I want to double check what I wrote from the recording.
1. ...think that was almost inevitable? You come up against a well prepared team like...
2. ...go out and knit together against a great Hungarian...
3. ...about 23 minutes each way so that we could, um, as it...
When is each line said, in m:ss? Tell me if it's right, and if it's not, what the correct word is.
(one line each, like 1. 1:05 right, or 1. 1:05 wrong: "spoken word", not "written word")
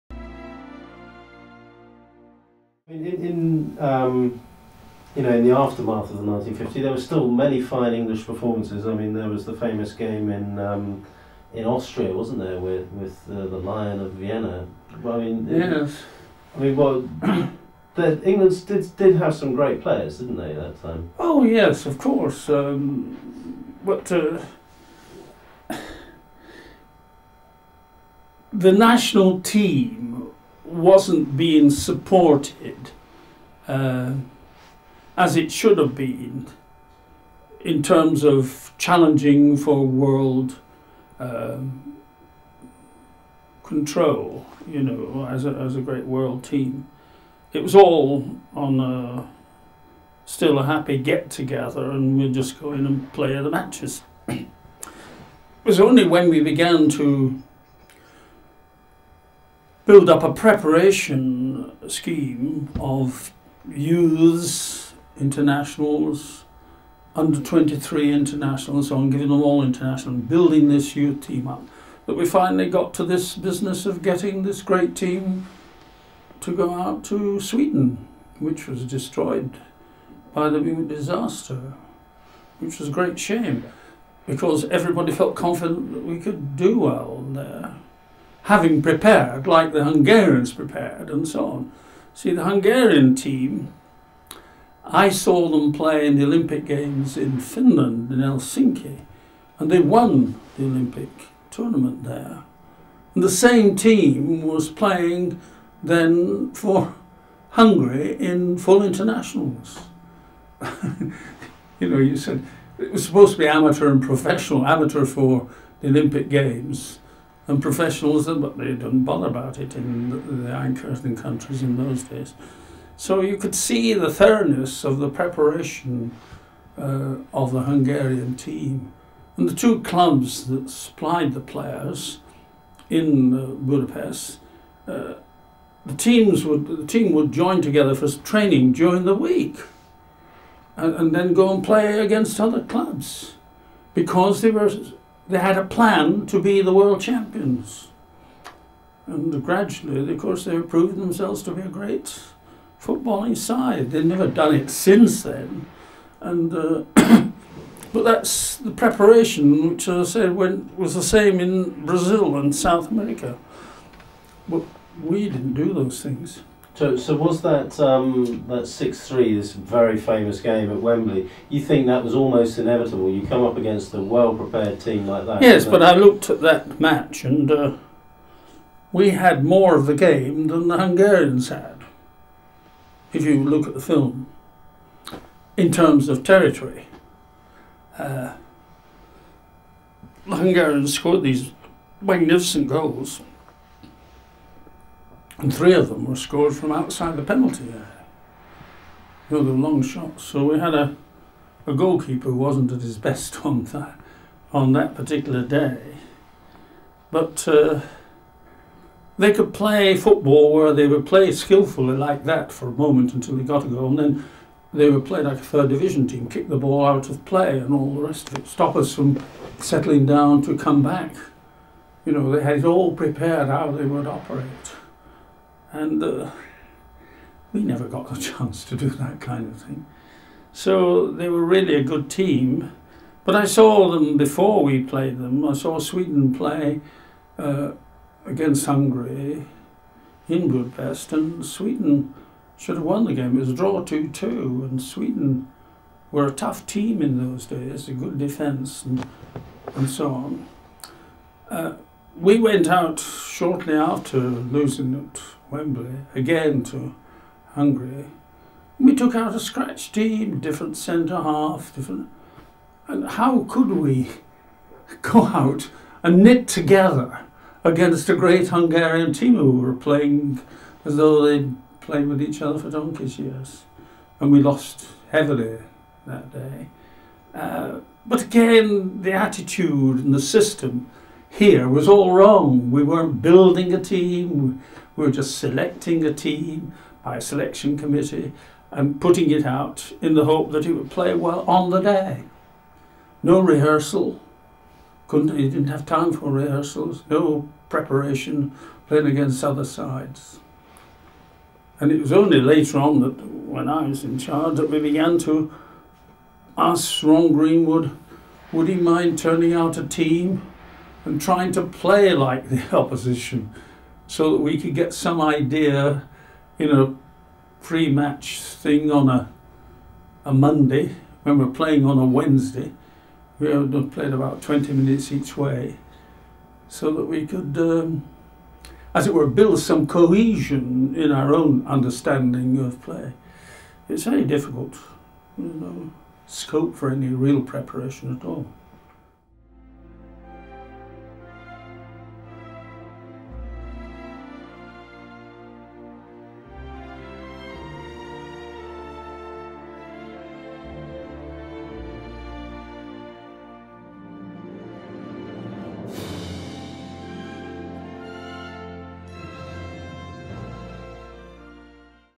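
1. 2:51 right
2. 4:25 right
3. 5:24 wrong: "20", not "23".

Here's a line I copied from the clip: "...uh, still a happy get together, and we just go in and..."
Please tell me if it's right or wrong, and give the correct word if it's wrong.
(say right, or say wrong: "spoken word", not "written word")
right.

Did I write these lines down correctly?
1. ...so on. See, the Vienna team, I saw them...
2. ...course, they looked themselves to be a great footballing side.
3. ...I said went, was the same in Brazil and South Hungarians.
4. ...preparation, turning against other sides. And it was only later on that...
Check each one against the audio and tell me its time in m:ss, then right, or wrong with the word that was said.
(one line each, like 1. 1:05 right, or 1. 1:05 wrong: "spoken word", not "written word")
1. 1:31 wrong: "Hungarian", not "Vienna"
2. 2:30 wrong: "proved", not "looked"
3. 2:39 wrong: "America", not "Hungarians"
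4. 4:57 wrong: "playing", not "turning".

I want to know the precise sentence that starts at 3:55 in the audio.
I saw Sweden play uh, against Hungary in Budapest, and Sweden should have won the game.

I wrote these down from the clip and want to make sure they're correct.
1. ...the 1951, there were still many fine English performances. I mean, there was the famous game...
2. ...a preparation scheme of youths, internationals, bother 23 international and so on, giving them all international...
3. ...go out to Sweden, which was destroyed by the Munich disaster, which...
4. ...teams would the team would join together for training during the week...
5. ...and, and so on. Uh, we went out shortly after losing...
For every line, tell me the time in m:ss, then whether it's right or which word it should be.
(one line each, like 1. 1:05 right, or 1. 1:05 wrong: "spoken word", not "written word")
1. 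0:06 wrong: "1950", not "1951"
2. 1:00 wrong: "under", not "bother"
3. 1:16 right
4. 2:15 right
5. 4:08 right.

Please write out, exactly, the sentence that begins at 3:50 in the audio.
So they were really a good team.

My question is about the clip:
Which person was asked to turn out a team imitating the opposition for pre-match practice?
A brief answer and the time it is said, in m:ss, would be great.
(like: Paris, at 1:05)
Ron Greenwood, at 5:07.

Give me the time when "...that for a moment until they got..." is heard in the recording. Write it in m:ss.
3:32.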